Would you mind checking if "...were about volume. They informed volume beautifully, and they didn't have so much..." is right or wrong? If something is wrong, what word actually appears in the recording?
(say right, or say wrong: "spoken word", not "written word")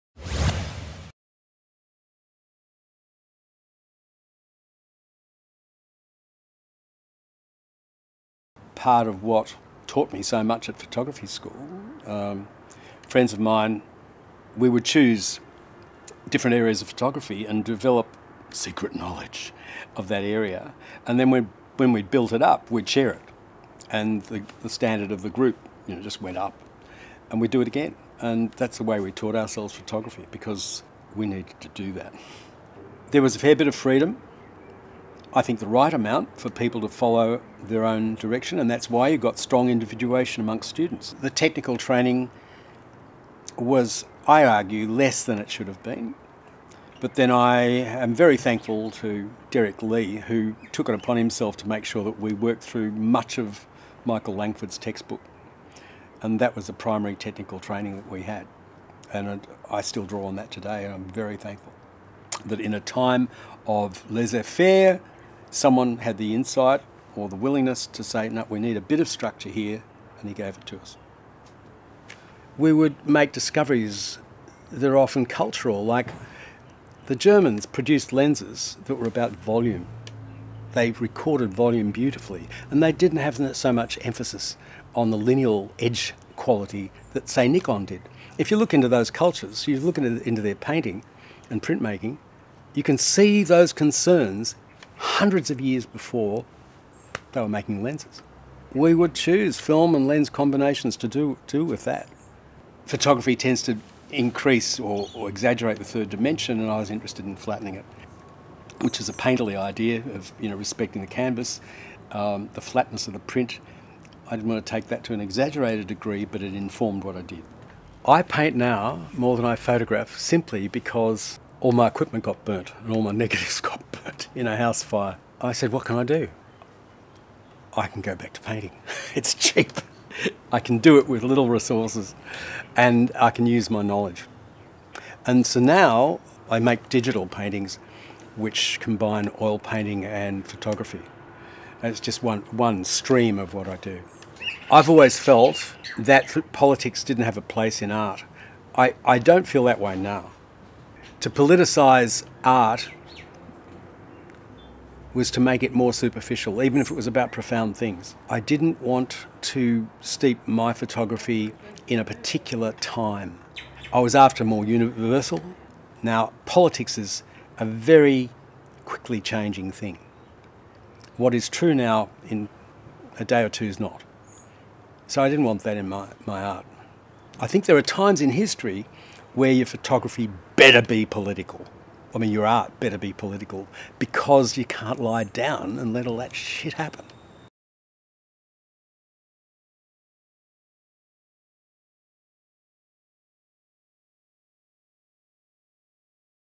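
wrong: "recorded", not "informed".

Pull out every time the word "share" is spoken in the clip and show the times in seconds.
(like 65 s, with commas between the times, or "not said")
22 s.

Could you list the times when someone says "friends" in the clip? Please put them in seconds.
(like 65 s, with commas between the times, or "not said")
13 s.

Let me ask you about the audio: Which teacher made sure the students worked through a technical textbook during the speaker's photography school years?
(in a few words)
Derrick Lee.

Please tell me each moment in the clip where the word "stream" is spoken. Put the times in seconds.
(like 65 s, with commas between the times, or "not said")
142 s.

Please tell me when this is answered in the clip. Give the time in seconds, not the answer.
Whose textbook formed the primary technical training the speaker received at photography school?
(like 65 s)
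54 s.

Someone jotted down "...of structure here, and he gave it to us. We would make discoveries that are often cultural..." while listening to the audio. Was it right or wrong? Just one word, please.
right.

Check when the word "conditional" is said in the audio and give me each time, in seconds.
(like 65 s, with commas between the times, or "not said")
not said.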